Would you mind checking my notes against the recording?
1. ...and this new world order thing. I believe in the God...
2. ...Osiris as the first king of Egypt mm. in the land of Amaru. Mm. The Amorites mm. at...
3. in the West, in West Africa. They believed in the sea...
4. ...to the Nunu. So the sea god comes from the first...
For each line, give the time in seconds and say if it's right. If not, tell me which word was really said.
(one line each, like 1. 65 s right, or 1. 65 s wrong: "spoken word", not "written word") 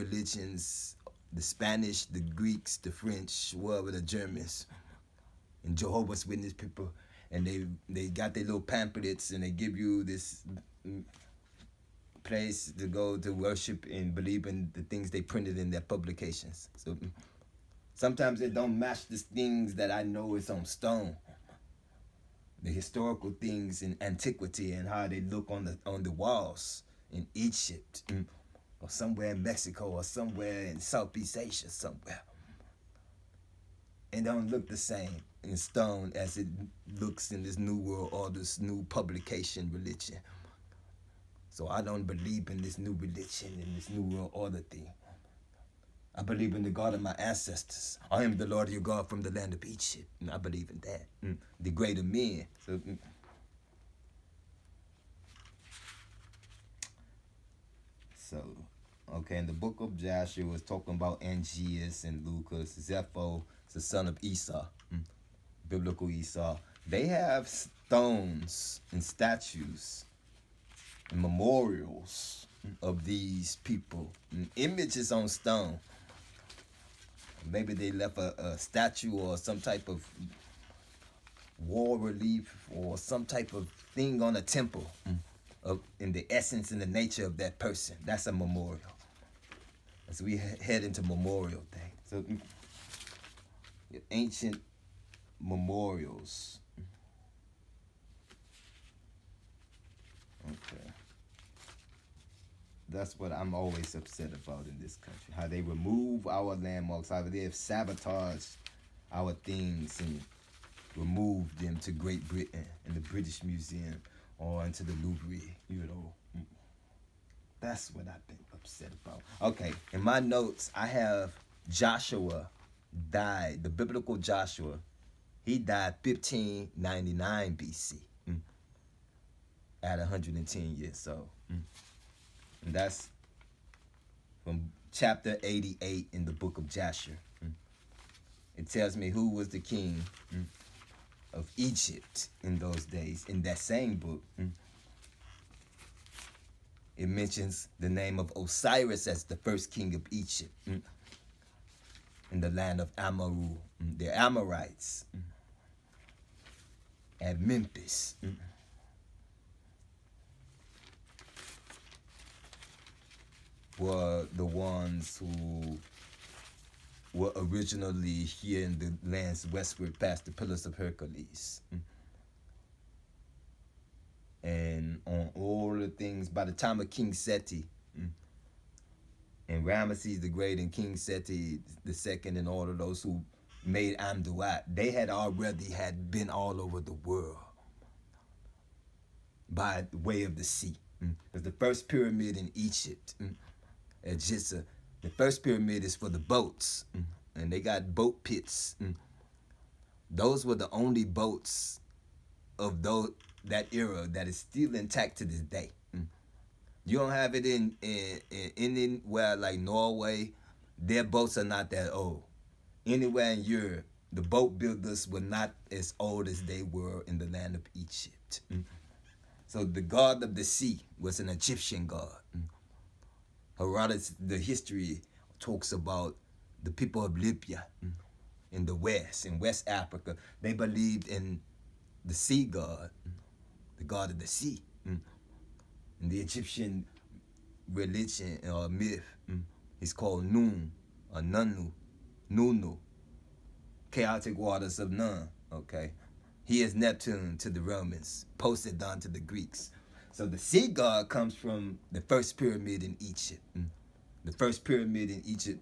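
1. 43 s right
2. 148 s right
3. 228 s right
4. 248 s wrong: "Greeks", not "Nunu".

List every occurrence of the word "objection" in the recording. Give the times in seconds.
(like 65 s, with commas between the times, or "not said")
not said.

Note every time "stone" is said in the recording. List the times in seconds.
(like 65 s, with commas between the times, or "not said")
20 s, 35 s, 67 s, 75 s.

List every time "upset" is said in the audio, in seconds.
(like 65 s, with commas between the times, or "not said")
103 s, 118 s.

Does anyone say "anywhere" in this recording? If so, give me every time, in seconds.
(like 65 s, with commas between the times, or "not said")
208 s, 212 s.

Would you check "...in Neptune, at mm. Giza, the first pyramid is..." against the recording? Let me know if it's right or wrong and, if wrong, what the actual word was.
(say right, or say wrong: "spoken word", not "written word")
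wrong: "Egypt", not "Neptune".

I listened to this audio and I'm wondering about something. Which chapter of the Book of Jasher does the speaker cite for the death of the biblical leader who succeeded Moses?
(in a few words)
88.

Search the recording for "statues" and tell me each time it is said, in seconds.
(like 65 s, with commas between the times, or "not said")
69 s, 78 s.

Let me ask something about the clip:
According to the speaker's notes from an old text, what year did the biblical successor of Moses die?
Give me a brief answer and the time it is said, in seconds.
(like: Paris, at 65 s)
1599 BC, at 126 s.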